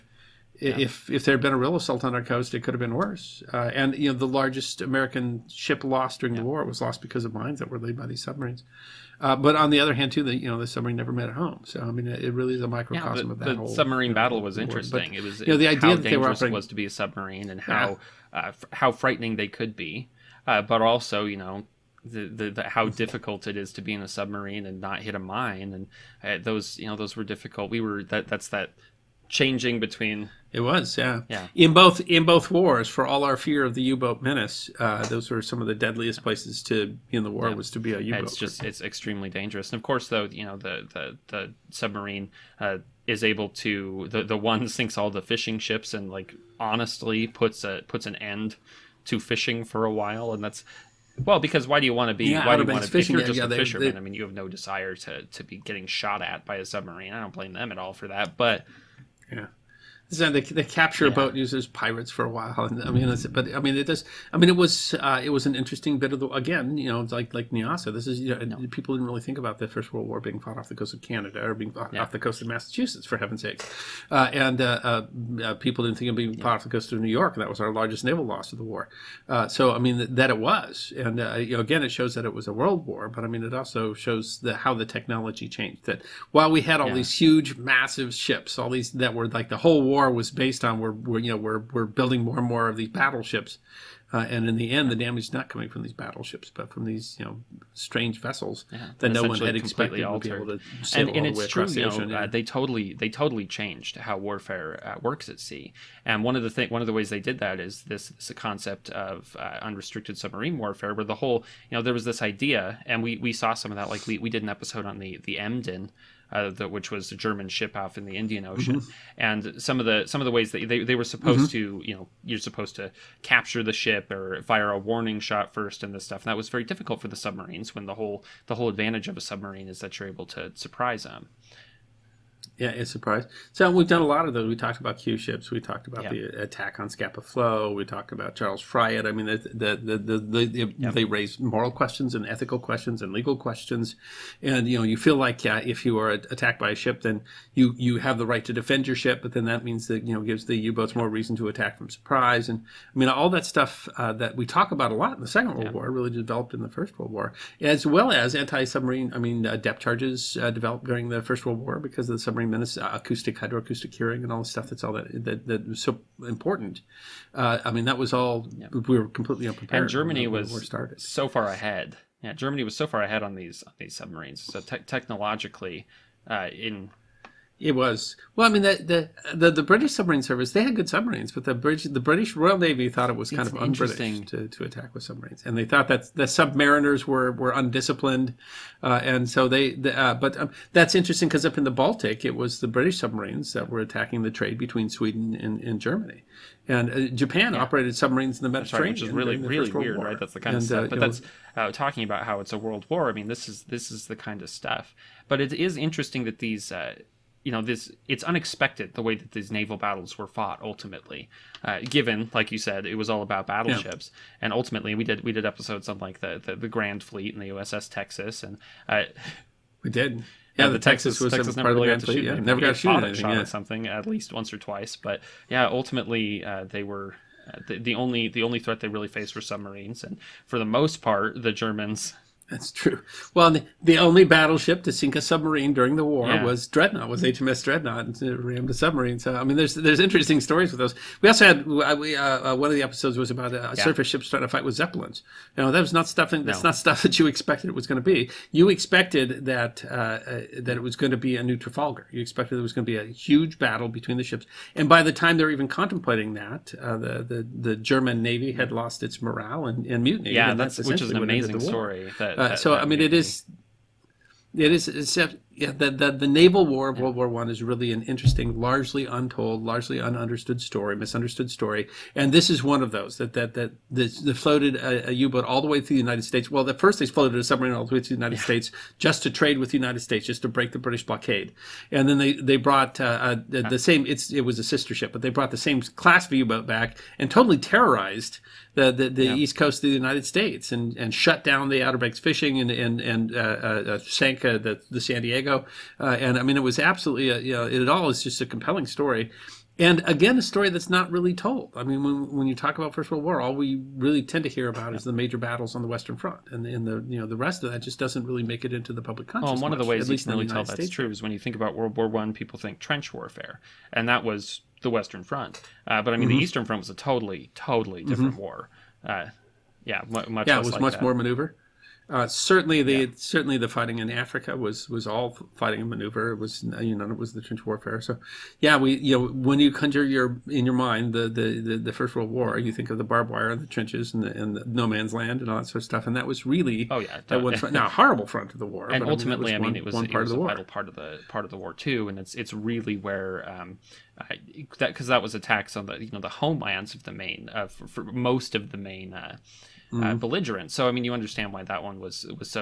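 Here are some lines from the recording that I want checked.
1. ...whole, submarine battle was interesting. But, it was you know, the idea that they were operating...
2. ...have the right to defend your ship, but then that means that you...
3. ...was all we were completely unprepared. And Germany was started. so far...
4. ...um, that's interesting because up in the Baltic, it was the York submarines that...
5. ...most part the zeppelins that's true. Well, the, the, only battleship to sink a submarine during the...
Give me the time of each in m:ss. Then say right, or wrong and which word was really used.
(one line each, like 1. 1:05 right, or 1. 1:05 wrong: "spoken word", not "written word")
1. 0:13 right
2. 2:27 right
3. 2:47 right
4. 3:10 wrong: "British", not "York"
5. 3:50 wrong: "germans", not "zeppelins".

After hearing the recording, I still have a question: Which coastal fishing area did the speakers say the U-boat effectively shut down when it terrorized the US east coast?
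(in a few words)
Outer Banks.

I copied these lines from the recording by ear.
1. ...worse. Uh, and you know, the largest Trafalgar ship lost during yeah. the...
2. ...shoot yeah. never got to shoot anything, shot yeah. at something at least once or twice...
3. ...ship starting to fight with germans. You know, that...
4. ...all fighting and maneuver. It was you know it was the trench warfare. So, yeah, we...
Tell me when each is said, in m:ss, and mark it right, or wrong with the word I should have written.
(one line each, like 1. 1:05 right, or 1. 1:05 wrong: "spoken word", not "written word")
1. 0:02 wrong: "American", not "Trafalgar"
2. 3:42 right
3. 4:04 wrong: "zeppelins", not "germans"
4. 5:25 right.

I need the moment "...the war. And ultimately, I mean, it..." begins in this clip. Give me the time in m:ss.
5:38.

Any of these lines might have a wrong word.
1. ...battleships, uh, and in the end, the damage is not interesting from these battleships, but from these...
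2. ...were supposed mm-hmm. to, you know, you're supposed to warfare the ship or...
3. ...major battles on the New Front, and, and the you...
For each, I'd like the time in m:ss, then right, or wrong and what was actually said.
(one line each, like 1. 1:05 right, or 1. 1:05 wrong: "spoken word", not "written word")
1. 1:32 wrong: "coming", not "interesting"
2. 2:00 wrong: "capture", not "warfare"
3. 5:05 wrong: "Western", not "New".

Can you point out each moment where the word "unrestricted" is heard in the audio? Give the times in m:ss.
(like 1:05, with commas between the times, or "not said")
1:49.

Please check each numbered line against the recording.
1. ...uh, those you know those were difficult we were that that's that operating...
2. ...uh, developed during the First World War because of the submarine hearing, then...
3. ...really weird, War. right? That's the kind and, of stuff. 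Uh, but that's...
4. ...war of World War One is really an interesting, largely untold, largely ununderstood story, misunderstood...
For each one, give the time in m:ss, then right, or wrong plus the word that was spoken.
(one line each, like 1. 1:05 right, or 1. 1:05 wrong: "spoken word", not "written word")
1. 0:26 wrong: "changing", not "operating"
2. 2:40 right
3. 3:19 right
4. 4:26 right.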